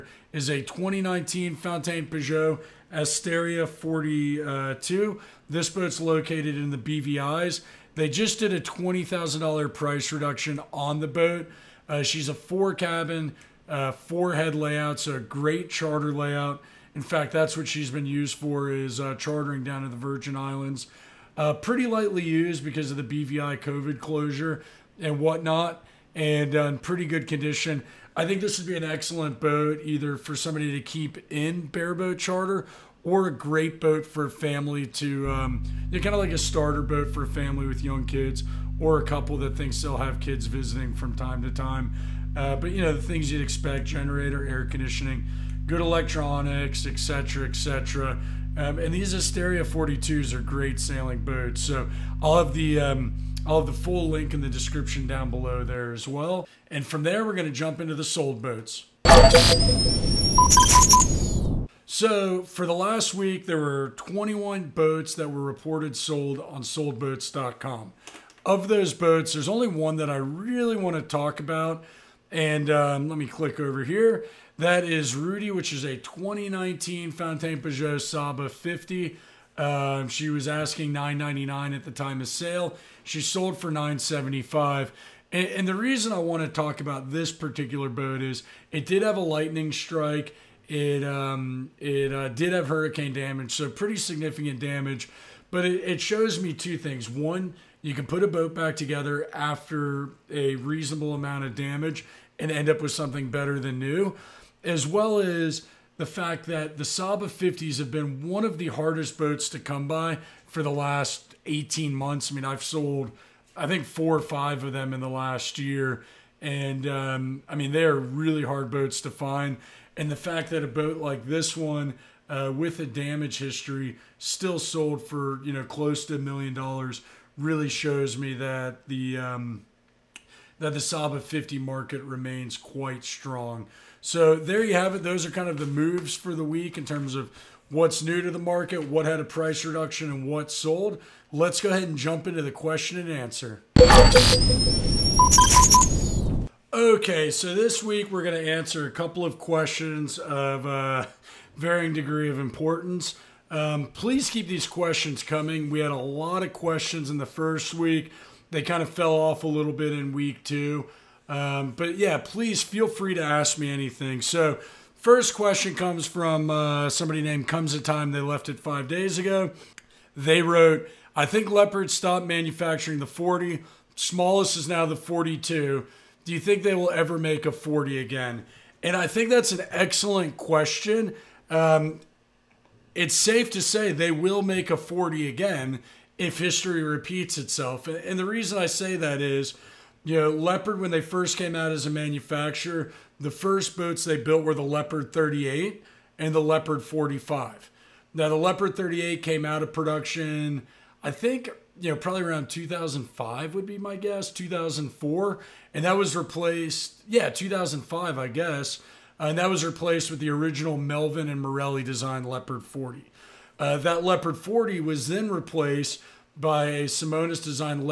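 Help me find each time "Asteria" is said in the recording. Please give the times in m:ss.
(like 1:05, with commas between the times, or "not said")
0:02, 0:49.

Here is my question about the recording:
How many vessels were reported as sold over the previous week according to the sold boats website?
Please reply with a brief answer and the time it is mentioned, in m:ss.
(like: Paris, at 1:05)
21, at 1:03.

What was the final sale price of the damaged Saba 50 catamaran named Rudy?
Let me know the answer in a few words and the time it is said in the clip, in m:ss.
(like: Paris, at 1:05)
9.75, at 1:23.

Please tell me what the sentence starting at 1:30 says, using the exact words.
It um, it uh, did have hurricane damage, so pretty significant damage.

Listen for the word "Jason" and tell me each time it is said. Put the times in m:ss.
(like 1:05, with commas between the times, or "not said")
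not said.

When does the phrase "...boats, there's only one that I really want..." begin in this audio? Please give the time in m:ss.
1:08.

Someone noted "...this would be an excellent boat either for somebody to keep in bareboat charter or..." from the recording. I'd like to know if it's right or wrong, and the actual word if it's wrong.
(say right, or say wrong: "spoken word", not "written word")
right.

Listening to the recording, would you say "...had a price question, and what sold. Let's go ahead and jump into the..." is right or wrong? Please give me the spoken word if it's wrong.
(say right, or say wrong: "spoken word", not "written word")
wrong: "reduction", not "question".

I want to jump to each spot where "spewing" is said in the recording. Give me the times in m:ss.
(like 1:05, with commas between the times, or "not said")
not said.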